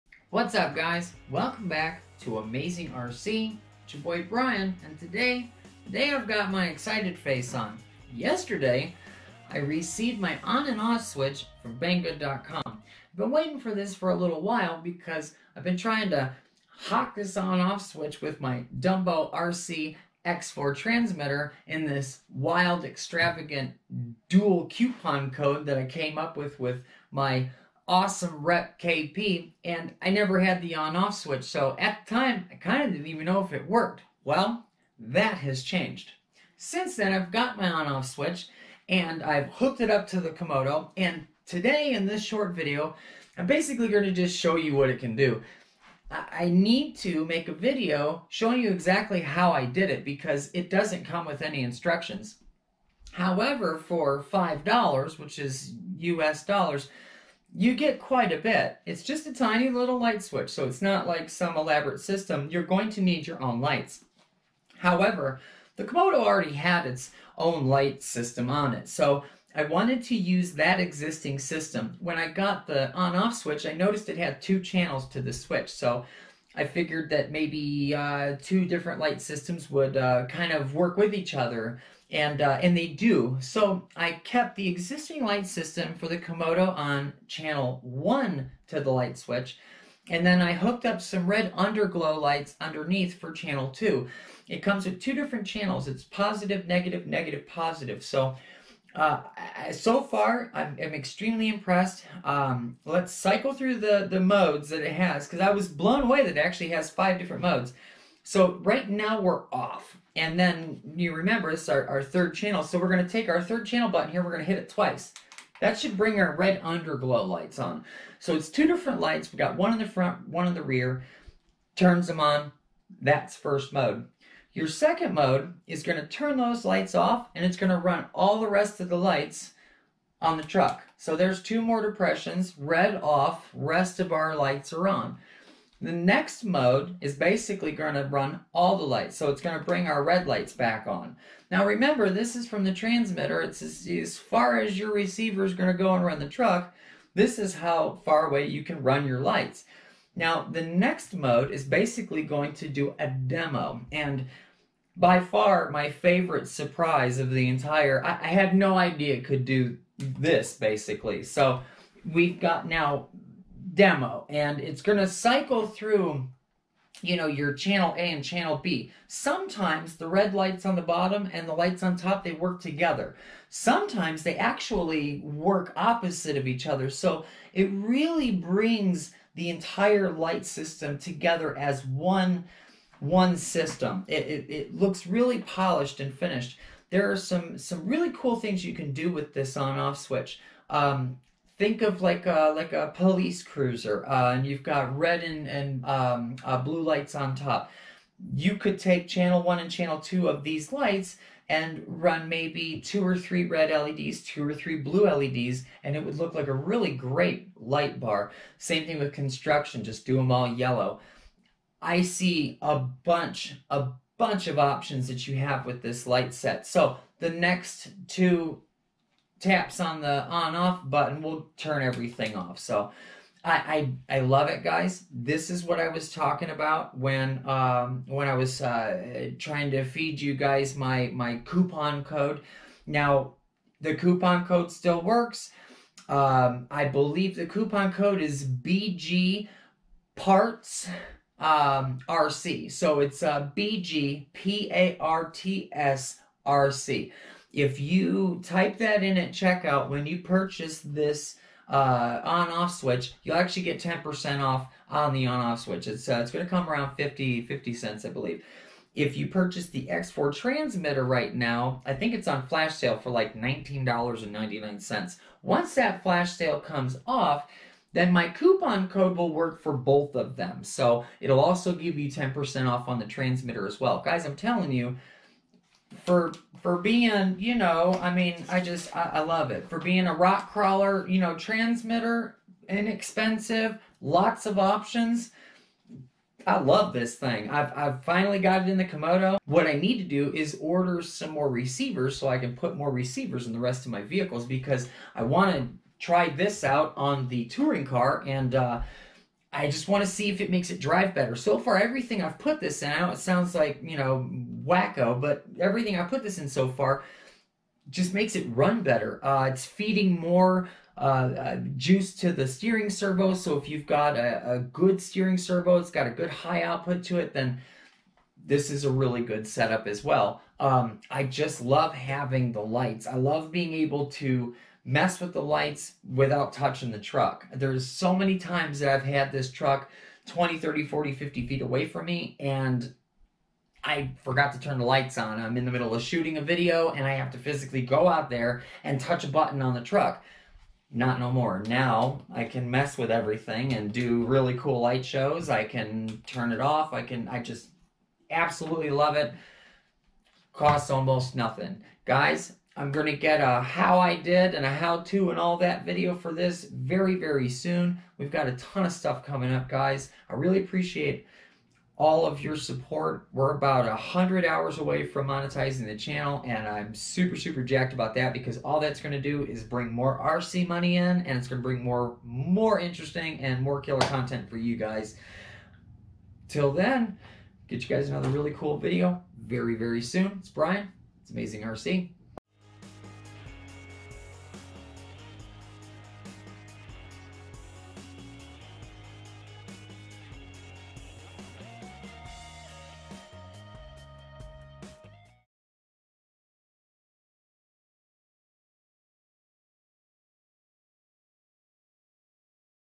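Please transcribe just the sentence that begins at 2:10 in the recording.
So there's two more depressions, red off, rest of our lights are on.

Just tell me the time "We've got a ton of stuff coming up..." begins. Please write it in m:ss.
5:58.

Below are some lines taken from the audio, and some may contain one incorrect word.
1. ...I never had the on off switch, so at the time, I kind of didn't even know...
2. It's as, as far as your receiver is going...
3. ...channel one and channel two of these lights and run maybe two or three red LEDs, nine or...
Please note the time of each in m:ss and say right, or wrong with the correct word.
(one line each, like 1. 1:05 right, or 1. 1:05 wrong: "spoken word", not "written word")
1. 0:30 right
2. 2:23 right
3. 3:19 wrong: "two", not "nine".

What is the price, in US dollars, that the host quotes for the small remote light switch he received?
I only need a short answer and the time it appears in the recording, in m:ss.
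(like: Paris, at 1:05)
$5, at 0:54.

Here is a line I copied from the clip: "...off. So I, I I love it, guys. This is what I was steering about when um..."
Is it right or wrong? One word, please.
wrong.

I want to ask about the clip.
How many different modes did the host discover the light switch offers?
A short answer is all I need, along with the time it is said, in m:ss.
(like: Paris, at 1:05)
5, at 1:46.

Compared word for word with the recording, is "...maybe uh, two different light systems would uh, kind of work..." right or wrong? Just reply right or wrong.
right.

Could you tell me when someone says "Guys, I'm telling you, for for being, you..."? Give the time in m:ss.
4:34.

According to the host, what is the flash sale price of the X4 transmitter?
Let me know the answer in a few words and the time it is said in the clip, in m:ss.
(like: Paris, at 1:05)
$19.99, at 4:23.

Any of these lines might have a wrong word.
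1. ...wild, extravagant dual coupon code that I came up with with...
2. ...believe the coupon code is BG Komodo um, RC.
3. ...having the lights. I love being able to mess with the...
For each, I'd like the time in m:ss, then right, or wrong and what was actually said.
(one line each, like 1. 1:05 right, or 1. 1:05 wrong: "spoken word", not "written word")
1. 0:22 right
2. 3:56 wrong: "Parts", not "Komodo"
3. 5:21 right.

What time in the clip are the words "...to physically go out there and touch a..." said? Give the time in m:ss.
5:37.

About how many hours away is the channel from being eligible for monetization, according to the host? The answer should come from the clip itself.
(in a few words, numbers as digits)
100 hours.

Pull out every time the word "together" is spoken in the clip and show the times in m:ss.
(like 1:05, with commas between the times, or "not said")
2:52, 3:00.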